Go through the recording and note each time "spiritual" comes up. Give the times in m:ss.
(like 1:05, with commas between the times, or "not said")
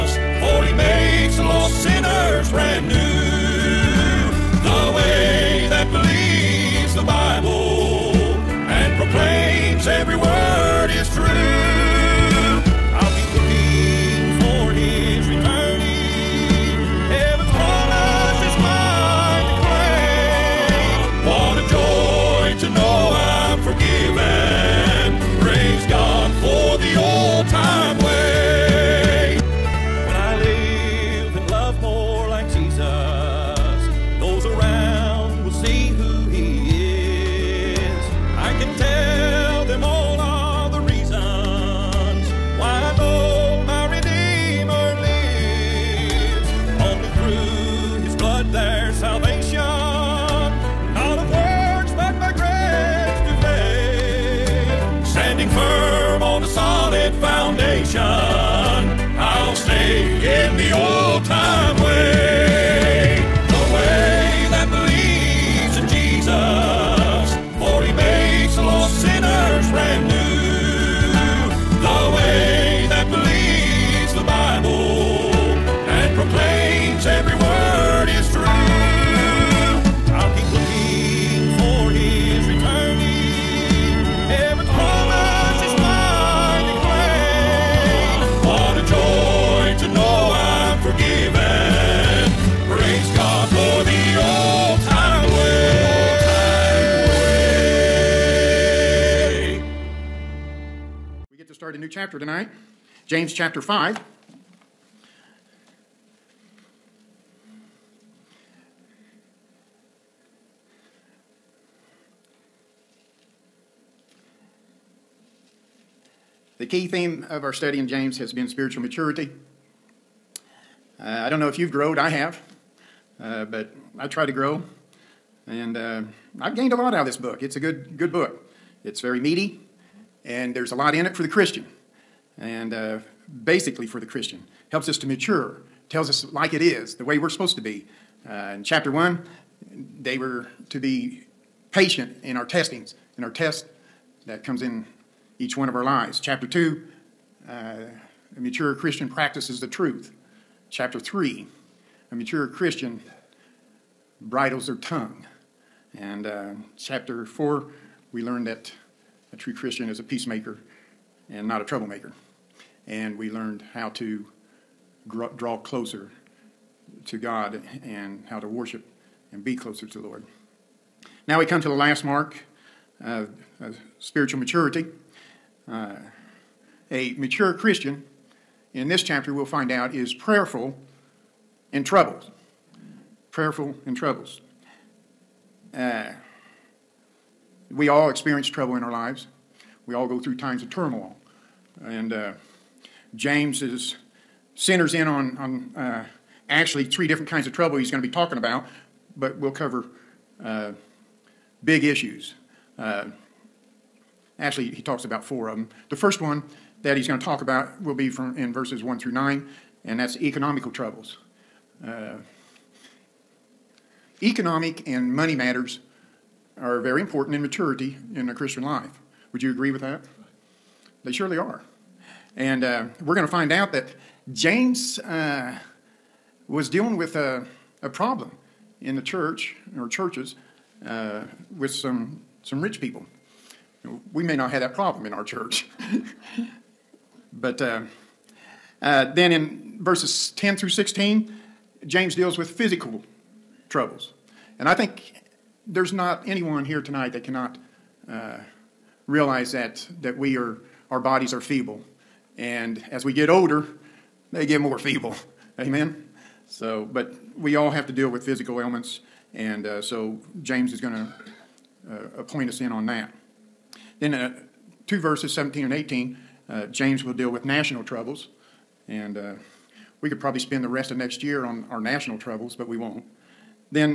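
1:58, 2:53.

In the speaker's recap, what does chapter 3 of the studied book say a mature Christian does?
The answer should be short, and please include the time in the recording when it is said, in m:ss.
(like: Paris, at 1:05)
Bridles their tongue, at 2:34.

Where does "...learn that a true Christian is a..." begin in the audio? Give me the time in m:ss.
2:38.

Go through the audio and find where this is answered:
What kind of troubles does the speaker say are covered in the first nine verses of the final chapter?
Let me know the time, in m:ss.
3:30.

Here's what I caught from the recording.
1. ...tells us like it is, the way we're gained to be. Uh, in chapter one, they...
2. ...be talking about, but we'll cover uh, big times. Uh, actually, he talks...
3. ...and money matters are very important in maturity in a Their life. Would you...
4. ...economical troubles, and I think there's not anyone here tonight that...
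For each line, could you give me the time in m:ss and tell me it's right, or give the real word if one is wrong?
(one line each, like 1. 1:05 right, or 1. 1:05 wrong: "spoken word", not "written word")
1. 2:15 wrong: "supposed", not "gained"
2. 3:18 wrong: "issues", not "times"
3. 3:34 wrong: "Christian", not "Their"
4. 4:02 wrong: "physical", not "economical".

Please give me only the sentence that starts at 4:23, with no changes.
Then uh, two verses, 17 and 18, uh, James will deal with national troubles.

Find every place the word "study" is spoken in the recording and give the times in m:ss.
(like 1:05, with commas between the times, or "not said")
1:57.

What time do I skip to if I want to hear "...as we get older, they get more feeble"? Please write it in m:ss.
4:12.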